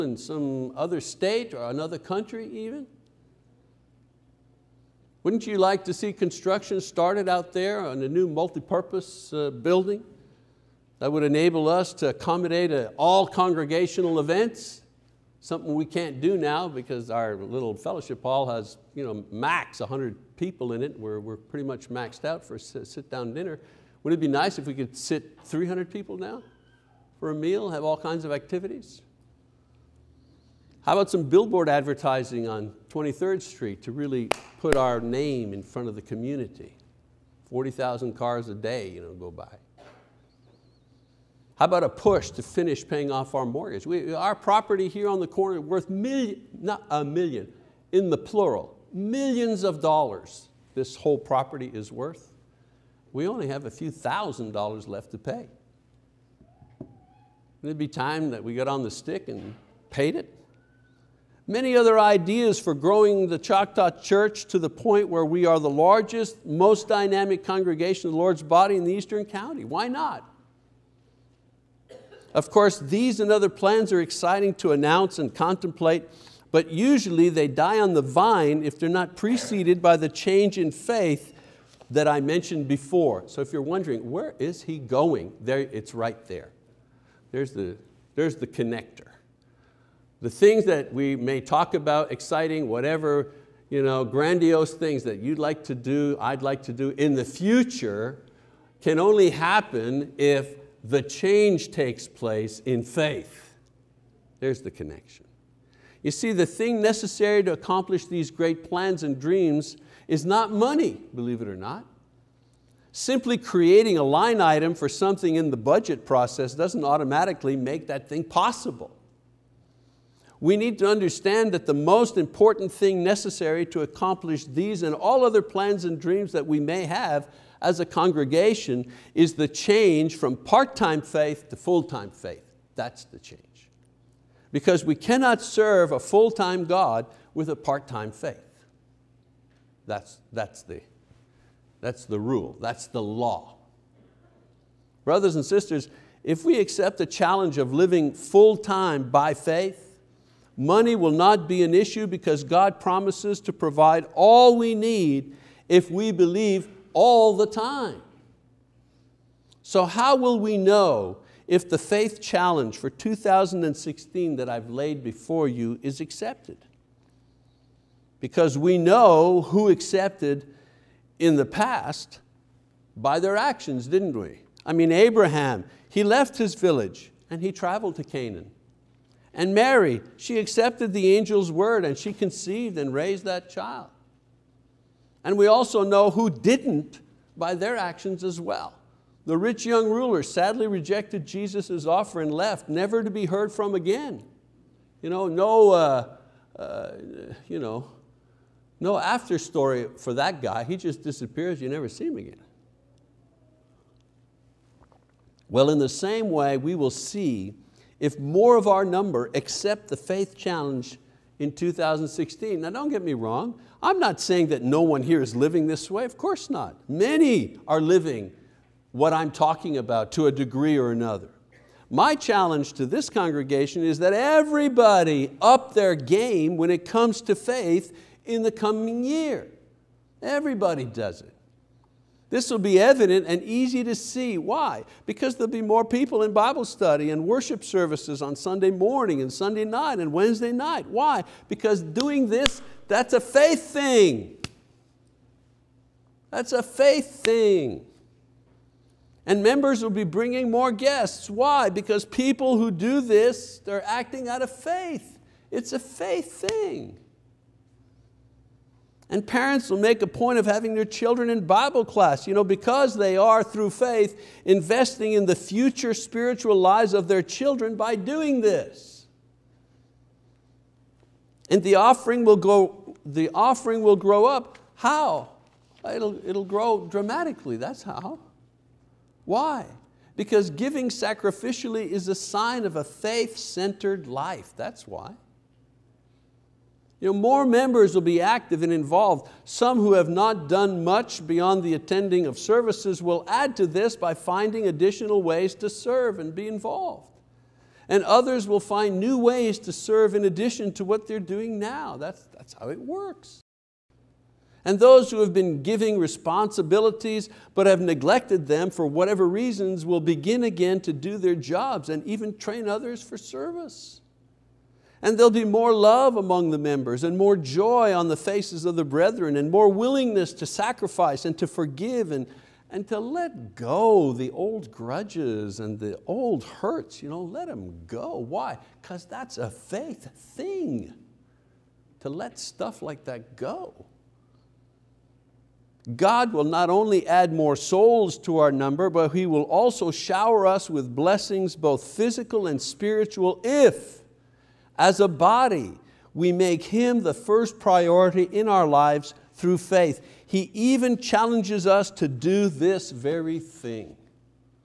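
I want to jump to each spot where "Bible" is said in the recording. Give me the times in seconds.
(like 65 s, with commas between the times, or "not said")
236 s, 261 s.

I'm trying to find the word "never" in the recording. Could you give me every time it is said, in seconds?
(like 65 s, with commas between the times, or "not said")
192 s, 201 s.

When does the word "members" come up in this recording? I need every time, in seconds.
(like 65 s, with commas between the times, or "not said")
249 s, 287 s, 316 s.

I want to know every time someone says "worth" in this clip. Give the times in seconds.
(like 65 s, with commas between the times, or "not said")
45 s, 51 s.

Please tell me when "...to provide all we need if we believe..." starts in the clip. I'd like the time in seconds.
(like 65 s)
153 s.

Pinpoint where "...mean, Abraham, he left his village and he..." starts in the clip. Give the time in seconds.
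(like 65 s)
174 s.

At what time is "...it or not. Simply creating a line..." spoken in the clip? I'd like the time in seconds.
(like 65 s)
111 s.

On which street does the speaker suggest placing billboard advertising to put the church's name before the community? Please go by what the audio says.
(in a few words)
23rd Street.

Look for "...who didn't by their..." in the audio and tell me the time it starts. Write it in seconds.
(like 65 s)
186 s.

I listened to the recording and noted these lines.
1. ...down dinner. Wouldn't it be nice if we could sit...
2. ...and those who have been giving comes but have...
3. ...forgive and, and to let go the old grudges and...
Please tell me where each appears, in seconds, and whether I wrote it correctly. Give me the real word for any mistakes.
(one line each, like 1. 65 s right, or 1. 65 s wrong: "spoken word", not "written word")
1. 23 s right
2. 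304 s wrong: "responsibilities", not "comes"
3. 321 s right.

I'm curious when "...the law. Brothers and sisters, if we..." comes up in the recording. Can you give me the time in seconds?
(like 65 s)
142 s.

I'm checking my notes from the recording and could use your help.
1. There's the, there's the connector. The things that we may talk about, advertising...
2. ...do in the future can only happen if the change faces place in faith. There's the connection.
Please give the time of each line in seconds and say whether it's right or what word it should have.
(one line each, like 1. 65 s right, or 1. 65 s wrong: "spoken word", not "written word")
1. 87 s wrong: "exciting", not "advertising"
2. 96 s wrong: "takes", not "faces".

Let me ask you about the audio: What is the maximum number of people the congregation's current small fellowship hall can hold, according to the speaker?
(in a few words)
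100.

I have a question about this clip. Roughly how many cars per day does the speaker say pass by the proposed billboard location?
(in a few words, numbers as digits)
40,000.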